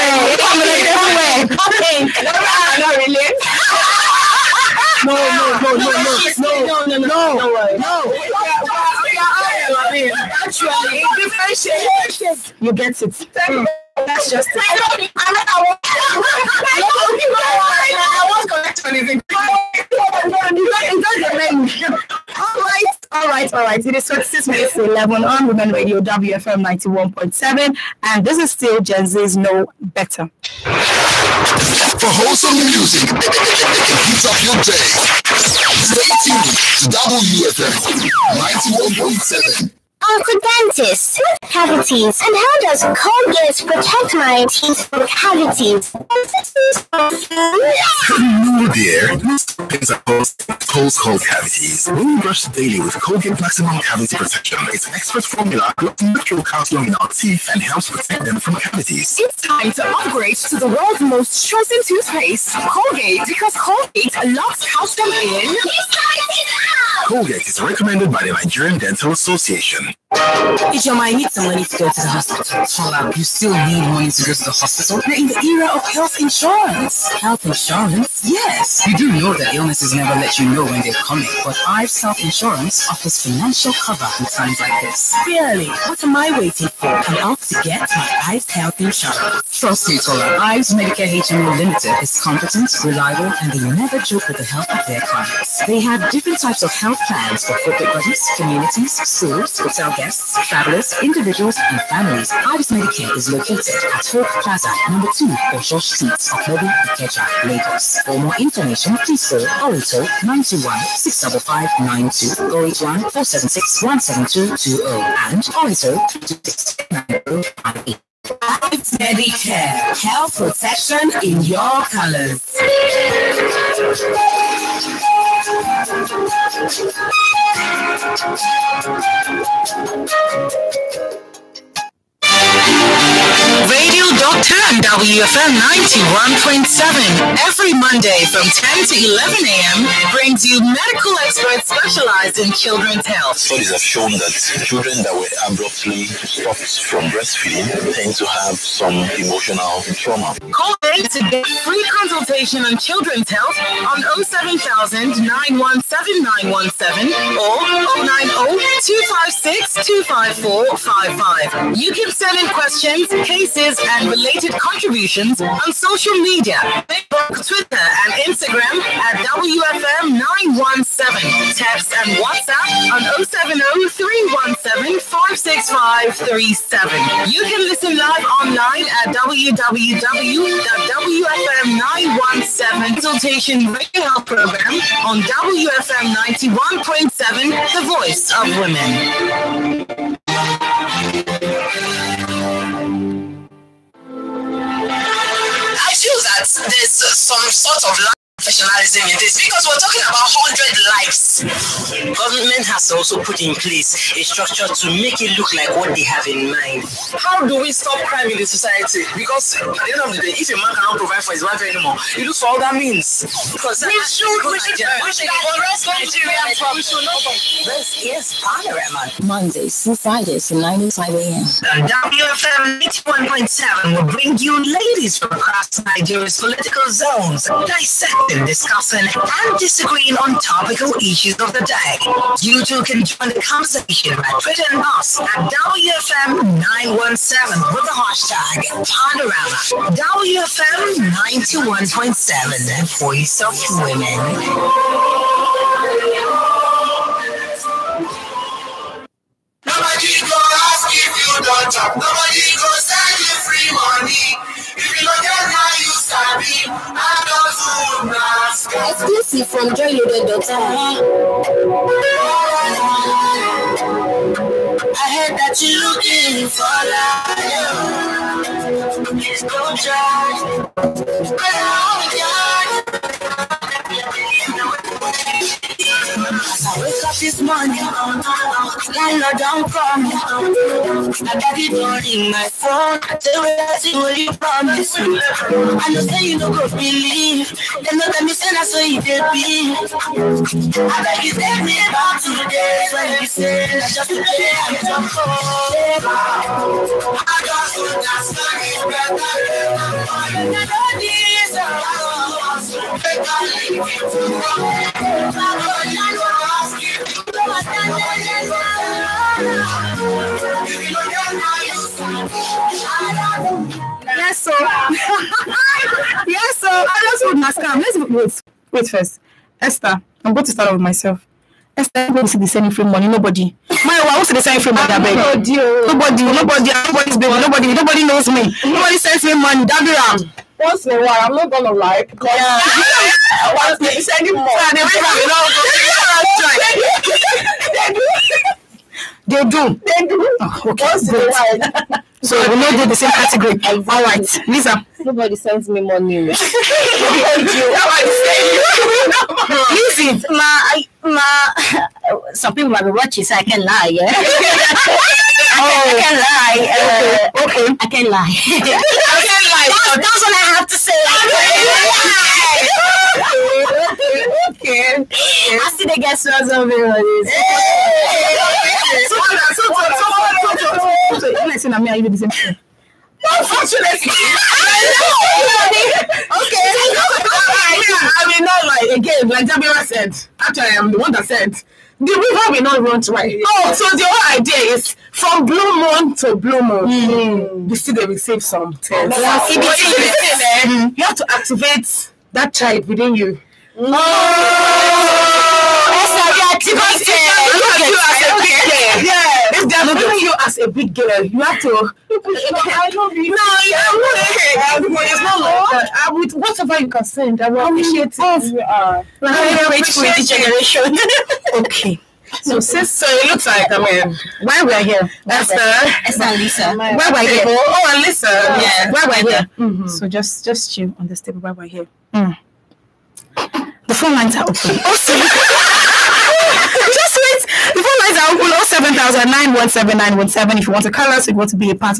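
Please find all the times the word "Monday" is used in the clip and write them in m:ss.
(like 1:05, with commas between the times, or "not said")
2:17, 3:39.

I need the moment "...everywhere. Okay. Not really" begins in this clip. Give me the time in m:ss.
0:01.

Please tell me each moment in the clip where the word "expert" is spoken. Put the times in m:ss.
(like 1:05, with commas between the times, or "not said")
0:54, 2:21.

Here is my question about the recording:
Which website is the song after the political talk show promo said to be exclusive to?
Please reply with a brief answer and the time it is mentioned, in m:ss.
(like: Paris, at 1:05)
joyloaded.com, at 4:19.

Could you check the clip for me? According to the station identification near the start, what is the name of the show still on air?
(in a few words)
Gen Z's Know Better.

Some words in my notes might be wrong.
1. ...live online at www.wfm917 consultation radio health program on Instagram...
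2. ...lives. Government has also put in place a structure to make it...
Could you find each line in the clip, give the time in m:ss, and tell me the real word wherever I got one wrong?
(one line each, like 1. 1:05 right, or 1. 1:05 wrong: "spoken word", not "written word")
1. 2:57 wrong: "WFM", not "Instagram"
2. 3:20 right.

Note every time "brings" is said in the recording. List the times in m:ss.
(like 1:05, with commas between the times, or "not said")
2:20, 3:44.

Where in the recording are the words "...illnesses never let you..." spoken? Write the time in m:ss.
1:19.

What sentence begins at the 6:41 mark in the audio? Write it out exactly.
if they are looking at you as a big girl, you have to.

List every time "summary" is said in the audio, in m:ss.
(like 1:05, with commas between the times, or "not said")
not said.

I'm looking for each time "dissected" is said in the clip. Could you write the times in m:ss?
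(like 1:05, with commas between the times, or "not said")
3:47.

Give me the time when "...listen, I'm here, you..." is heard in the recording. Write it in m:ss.
6:11.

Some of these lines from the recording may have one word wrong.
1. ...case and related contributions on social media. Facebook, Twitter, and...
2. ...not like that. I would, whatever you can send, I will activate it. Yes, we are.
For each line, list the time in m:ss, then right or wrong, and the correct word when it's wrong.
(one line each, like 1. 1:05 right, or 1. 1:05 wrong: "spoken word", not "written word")
1. 2:43 right
2. 6:45 wrong: "appreciate", not "activate".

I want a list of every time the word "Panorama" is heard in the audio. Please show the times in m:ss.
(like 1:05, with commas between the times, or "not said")
3:38, 3:58.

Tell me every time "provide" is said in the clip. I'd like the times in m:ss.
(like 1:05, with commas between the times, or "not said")
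3:30.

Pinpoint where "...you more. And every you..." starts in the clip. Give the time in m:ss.
5:34.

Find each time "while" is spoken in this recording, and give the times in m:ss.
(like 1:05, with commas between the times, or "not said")
5:31, 5:41.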